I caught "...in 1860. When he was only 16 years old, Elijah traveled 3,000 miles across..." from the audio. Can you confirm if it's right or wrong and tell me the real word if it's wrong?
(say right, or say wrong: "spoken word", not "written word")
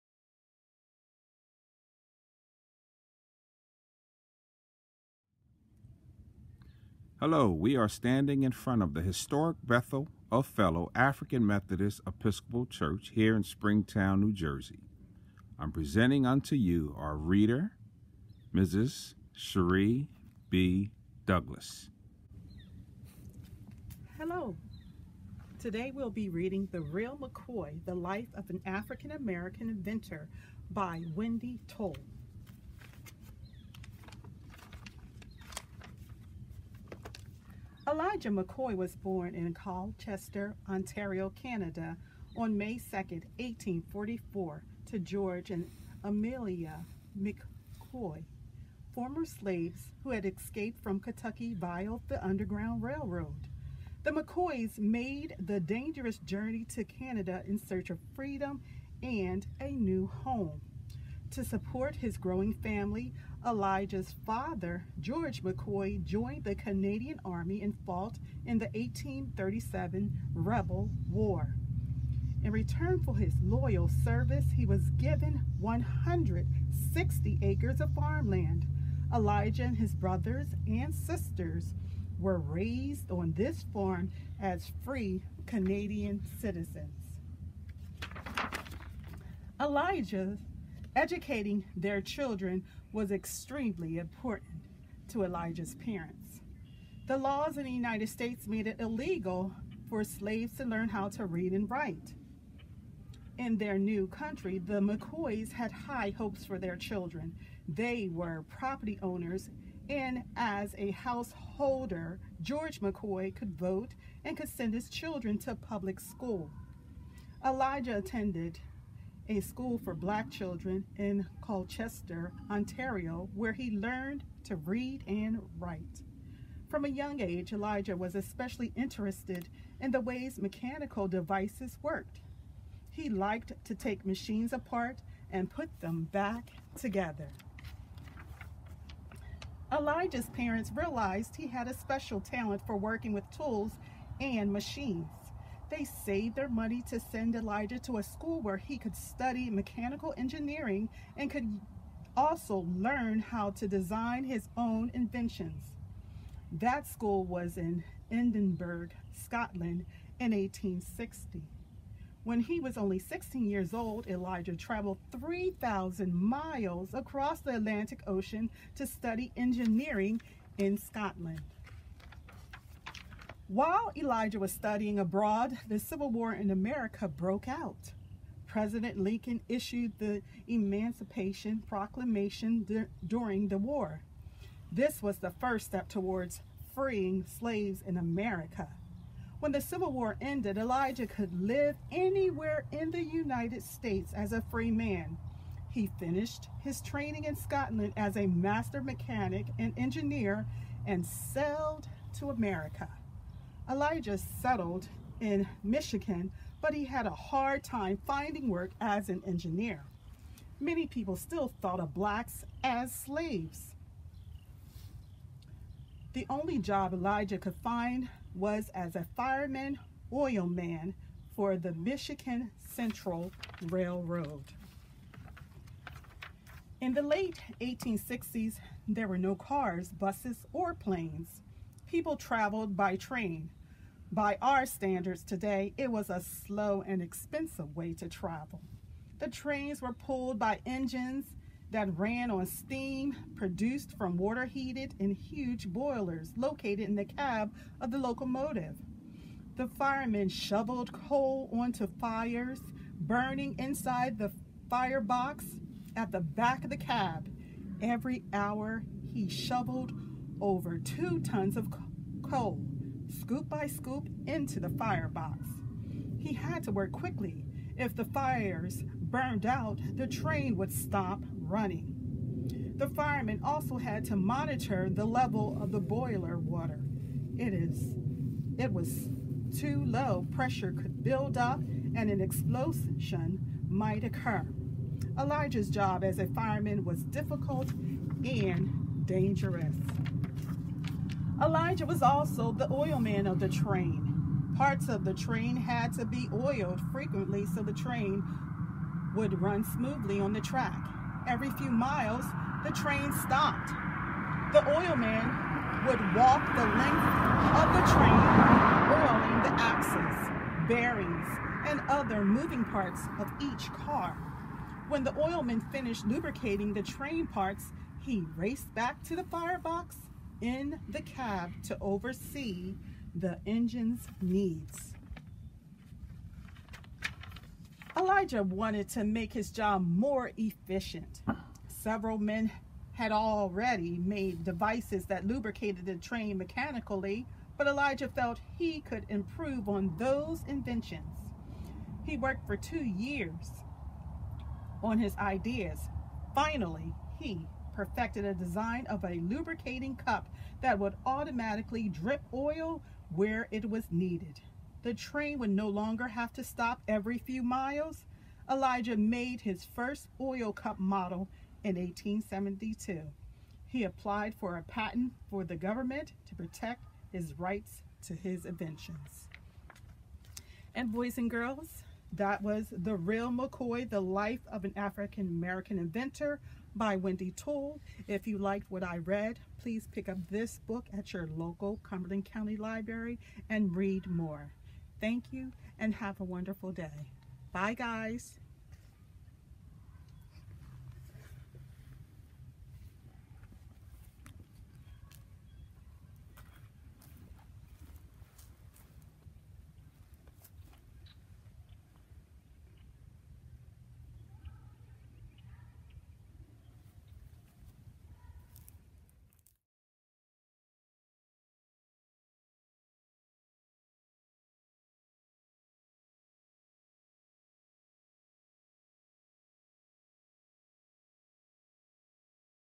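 right.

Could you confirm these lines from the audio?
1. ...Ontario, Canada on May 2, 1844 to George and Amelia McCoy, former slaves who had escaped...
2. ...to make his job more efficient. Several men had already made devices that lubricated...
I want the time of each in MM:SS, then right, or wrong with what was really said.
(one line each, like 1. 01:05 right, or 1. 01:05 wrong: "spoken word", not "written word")
1. 00:40 right
2. 05:28 right.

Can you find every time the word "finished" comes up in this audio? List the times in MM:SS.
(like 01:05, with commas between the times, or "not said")
03:15, 05:15.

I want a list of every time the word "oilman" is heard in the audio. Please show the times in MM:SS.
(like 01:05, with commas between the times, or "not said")
04:52, 05:04, 05:15.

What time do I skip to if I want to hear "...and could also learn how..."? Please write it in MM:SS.
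02:31.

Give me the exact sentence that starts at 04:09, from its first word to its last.
The firemen shoveled coal onto fires burning inside the firebox at the back of the cab.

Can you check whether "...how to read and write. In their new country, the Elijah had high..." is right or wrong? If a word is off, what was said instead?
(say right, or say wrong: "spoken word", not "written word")
wrong: "McCoys", not "Elijah".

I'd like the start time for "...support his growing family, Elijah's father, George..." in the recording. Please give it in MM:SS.
01:01.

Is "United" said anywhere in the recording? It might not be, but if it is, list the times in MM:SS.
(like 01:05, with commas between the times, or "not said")
01:37, 03:13.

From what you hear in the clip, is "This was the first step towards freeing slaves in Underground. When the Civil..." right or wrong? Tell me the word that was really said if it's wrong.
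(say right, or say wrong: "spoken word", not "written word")
wrong: "America", not "Underground".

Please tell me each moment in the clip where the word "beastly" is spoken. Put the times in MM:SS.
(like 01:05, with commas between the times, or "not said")
not said.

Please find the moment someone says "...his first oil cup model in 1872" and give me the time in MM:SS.
05:59.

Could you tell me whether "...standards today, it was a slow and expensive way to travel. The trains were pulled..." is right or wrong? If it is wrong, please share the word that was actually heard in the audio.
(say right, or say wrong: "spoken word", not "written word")
right.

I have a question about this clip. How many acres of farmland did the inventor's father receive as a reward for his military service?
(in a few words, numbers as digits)
160.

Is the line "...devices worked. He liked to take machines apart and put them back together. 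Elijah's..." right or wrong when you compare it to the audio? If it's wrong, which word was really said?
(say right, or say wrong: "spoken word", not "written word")
right.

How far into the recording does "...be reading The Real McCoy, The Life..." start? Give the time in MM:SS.
00:26.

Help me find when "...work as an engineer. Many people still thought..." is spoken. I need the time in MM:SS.
03:28.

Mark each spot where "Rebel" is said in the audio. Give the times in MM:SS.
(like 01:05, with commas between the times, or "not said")
01:10.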